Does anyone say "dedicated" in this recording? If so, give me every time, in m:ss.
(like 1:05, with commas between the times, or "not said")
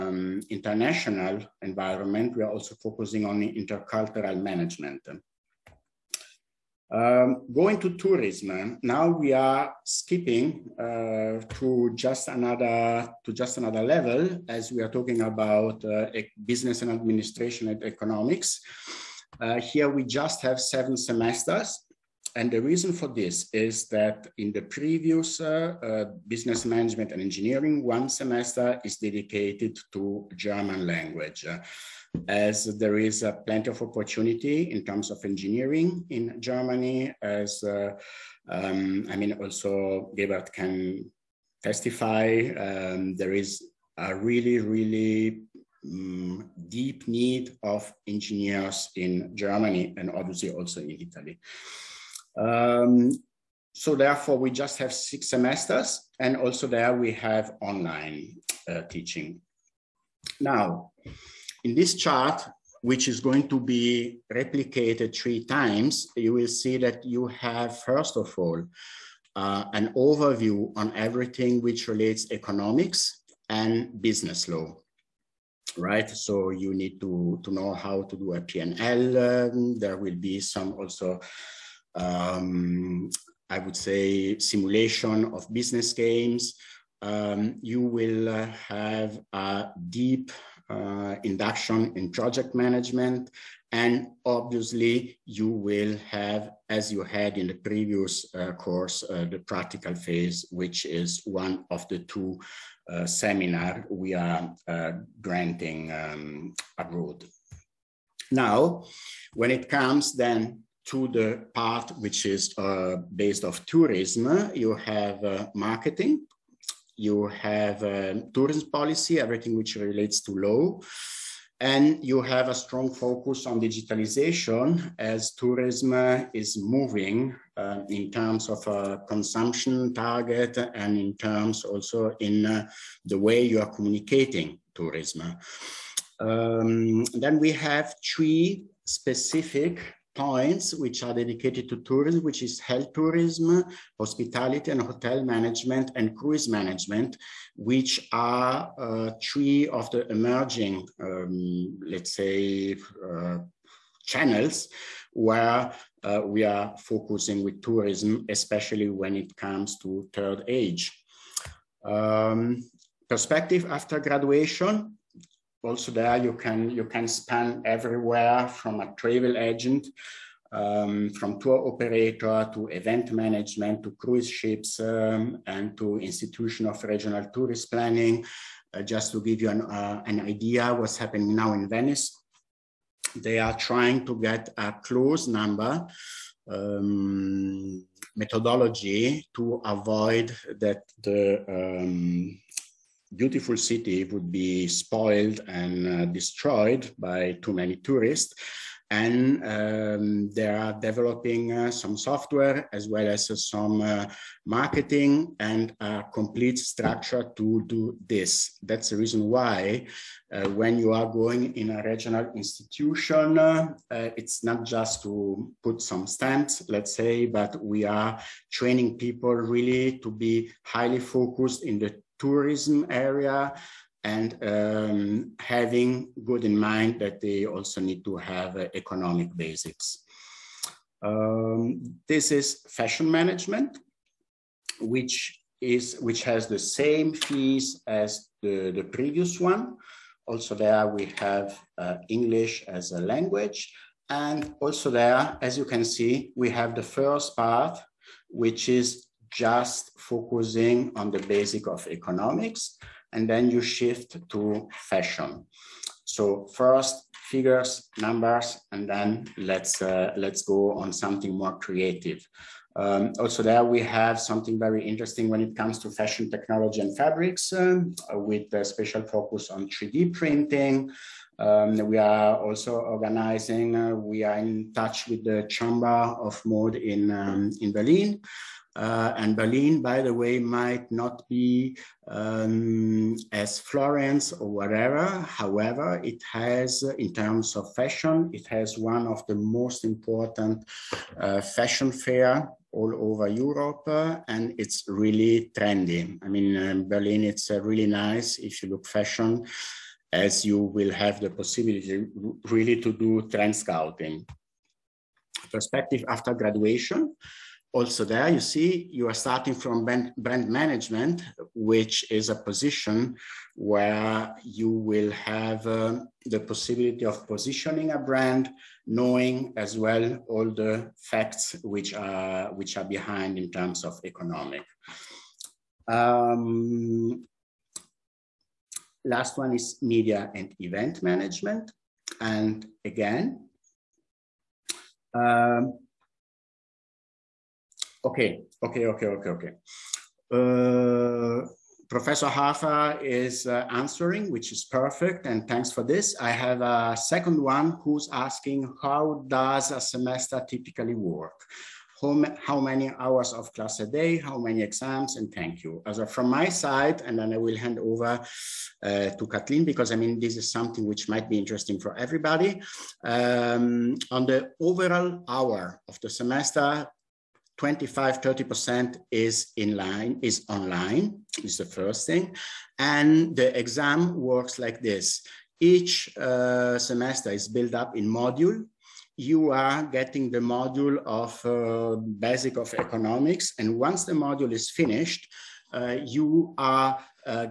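0:28, 2:21.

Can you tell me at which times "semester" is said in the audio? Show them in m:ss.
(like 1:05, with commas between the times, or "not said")
0:20, 0:28, 0:55, 5:49, 6:06, 6:16.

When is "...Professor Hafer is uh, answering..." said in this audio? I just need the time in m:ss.
5:41.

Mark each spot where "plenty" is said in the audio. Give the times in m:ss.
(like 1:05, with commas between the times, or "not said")
0:33.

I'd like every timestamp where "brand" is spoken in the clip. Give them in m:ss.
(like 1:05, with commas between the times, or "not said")
5:10, 5:17.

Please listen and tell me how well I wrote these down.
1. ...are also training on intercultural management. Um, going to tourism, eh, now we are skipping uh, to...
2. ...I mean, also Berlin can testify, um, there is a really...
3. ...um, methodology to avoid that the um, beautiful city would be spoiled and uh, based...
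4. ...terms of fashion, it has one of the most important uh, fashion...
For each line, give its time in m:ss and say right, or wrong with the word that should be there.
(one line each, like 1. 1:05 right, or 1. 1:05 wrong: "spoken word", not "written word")
1. 0:02 wrong: "focusing", not "training"
2. 0:39 wrong: "Gebhardt", not "Berlin"
3. 3:06 wrong: "destroyed", not "based"
4. 4:47 right.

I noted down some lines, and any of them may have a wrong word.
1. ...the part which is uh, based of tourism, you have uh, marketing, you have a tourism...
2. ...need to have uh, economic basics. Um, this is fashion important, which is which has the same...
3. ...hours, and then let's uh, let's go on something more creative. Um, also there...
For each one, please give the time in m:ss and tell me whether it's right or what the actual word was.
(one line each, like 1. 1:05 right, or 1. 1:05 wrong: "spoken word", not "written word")
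1. 1:51 right
2. 3:47 wrong: "management", not "important"
3. 4:17 wrong: "numbers", not "hours".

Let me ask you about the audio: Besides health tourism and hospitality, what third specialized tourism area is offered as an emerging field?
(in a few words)
Cruise management.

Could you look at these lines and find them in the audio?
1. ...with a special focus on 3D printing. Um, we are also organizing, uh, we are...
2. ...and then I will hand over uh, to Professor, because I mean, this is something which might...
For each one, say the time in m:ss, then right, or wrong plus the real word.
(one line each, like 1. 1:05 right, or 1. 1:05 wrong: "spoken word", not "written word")
1. 4:28 right
2. 5:57 wrong: "Kathleen", not "Professor".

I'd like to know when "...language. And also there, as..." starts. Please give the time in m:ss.
4:03.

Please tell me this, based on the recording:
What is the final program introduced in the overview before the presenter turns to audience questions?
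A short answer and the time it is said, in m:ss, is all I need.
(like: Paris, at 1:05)
Media and event management, at 5:29.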